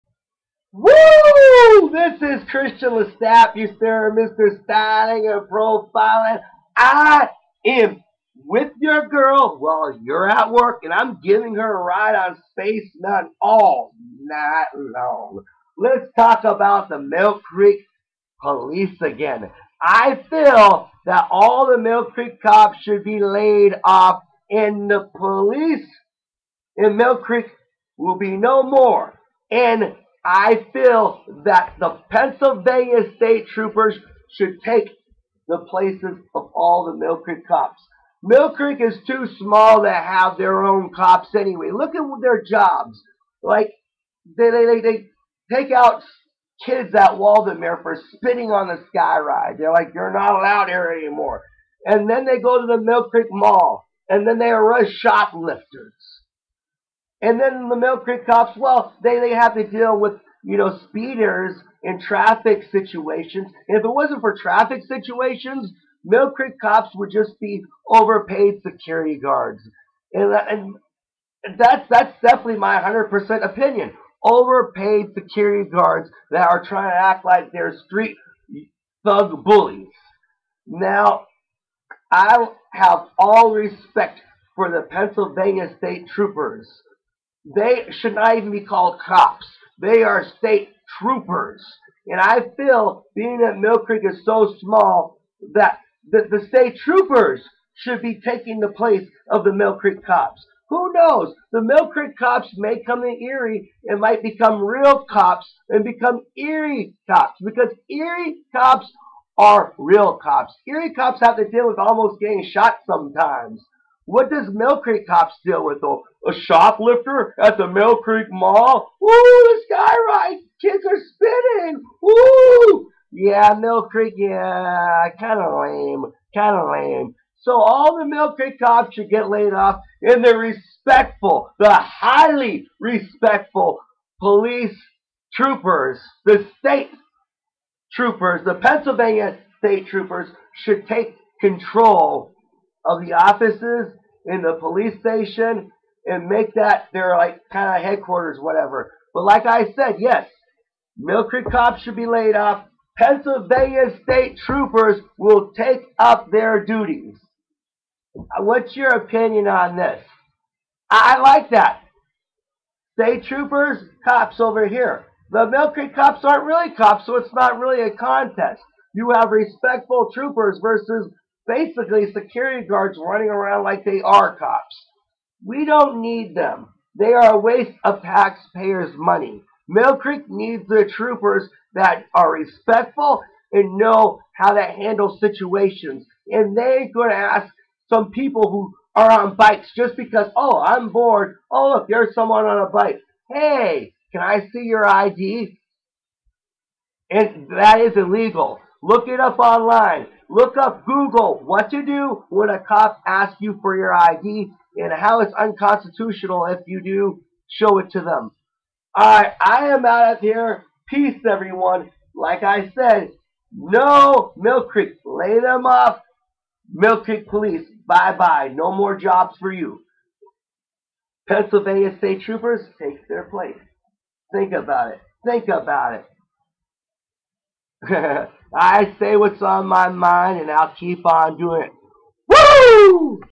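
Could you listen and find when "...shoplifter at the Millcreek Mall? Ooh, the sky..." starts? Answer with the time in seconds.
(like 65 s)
116 s.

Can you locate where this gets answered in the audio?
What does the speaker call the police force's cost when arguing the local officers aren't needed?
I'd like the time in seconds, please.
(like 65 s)
177 s.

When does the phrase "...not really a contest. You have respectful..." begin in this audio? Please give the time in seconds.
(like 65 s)
167 s.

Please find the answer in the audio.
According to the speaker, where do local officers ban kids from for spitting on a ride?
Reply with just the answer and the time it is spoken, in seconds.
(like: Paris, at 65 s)
Waldameer, at 47 s.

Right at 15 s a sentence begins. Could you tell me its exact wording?
Let's talk about the Mill Creek police again.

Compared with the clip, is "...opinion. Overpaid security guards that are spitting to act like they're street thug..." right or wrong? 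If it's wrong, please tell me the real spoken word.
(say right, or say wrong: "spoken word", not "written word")
wrong: "trying", not "spitting".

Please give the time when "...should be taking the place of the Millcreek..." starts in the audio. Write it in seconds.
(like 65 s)
97 s.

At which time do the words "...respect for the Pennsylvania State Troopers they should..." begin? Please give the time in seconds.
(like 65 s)
83 s.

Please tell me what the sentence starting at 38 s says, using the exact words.
Millcreek is too small to have their own cops anyway.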